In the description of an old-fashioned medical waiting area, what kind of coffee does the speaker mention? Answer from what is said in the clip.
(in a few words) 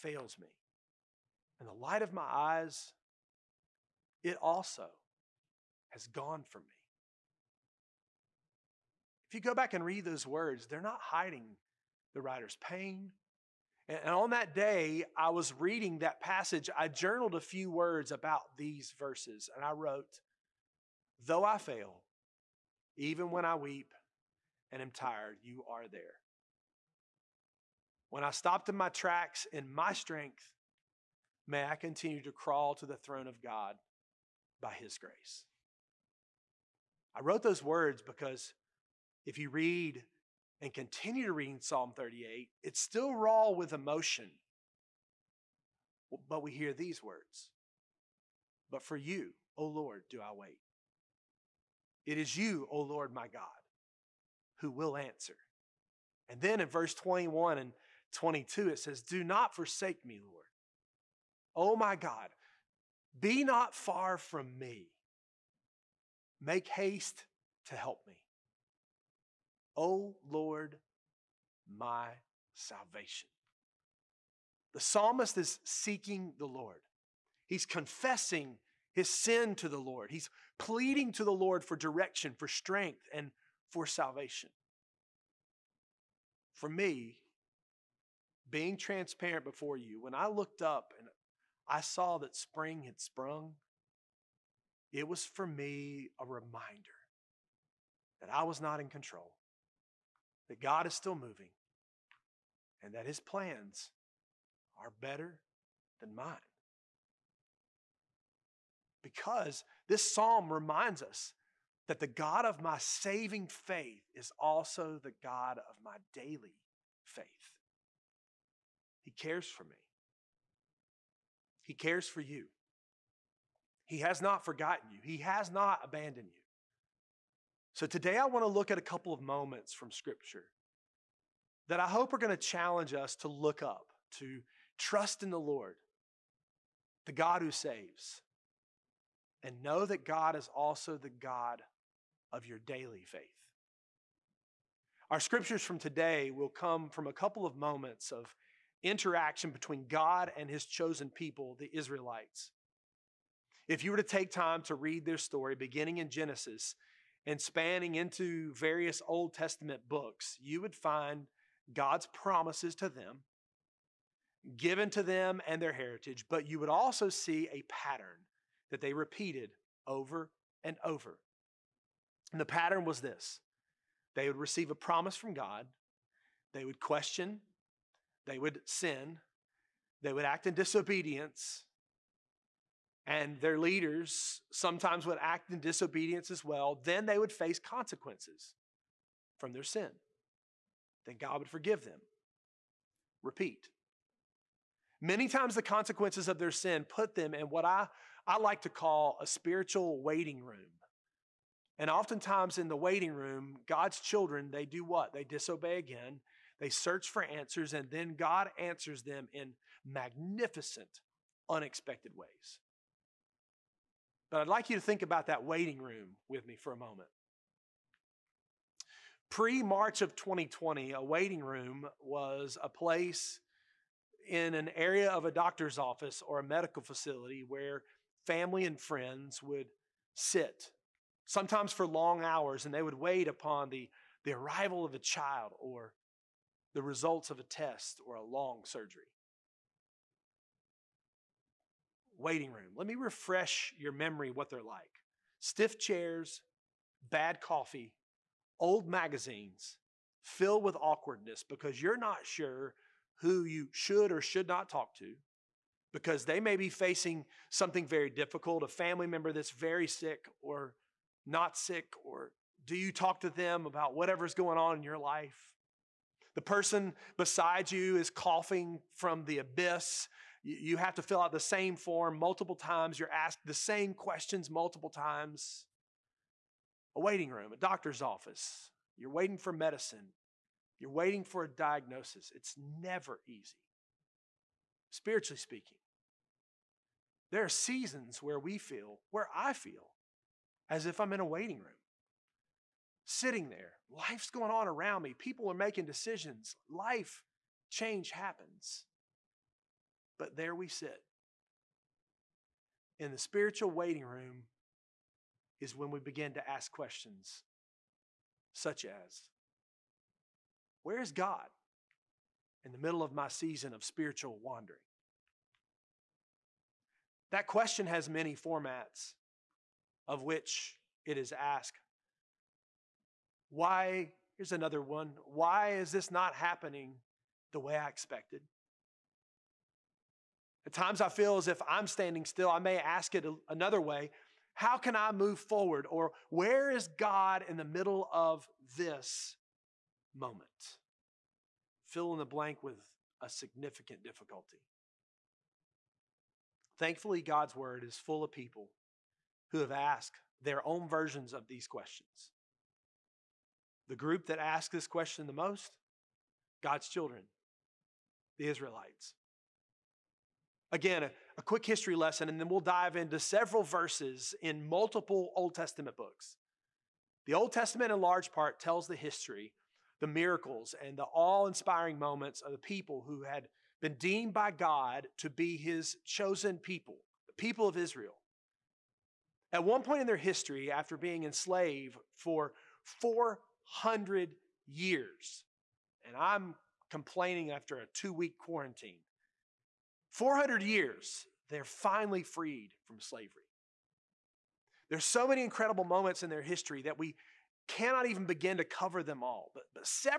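bad coffee.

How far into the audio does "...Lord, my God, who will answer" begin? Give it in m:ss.
0:52.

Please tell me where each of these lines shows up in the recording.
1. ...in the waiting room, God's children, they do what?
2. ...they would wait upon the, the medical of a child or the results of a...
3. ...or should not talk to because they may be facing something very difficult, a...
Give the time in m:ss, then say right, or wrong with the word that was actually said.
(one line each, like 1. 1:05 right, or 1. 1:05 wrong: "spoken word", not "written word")
1. 3:22 right
2. 3:52 wrong: "arrival", not "medical"
3. 4:14 right.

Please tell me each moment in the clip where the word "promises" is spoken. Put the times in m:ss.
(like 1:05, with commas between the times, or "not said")
2:42, 2:54.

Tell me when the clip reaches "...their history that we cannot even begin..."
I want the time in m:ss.
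6:36.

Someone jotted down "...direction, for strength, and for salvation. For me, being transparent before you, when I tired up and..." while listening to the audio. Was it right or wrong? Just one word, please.
wrong.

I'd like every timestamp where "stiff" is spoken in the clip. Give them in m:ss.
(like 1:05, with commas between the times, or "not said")
4:05.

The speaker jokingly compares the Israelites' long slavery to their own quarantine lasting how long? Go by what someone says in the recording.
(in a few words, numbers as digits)
2 weeks.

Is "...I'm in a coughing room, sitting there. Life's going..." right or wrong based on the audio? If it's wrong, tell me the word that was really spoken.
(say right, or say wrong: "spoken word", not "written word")
wrong: "waiting", not "coughing".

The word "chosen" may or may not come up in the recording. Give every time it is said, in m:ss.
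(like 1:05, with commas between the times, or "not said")
2:30, 6:16.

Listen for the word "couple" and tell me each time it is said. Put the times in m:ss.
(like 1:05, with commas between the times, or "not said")
2:08, 2:27.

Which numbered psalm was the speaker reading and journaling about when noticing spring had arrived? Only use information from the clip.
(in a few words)
Psalm 38.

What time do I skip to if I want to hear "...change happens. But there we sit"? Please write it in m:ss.
4:57.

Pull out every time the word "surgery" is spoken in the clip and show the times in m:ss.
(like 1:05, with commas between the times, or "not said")
3:58.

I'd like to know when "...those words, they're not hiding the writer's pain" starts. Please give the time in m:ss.
0:10.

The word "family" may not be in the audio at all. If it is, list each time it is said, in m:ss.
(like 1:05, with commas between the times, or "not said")
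3:48, 4:18.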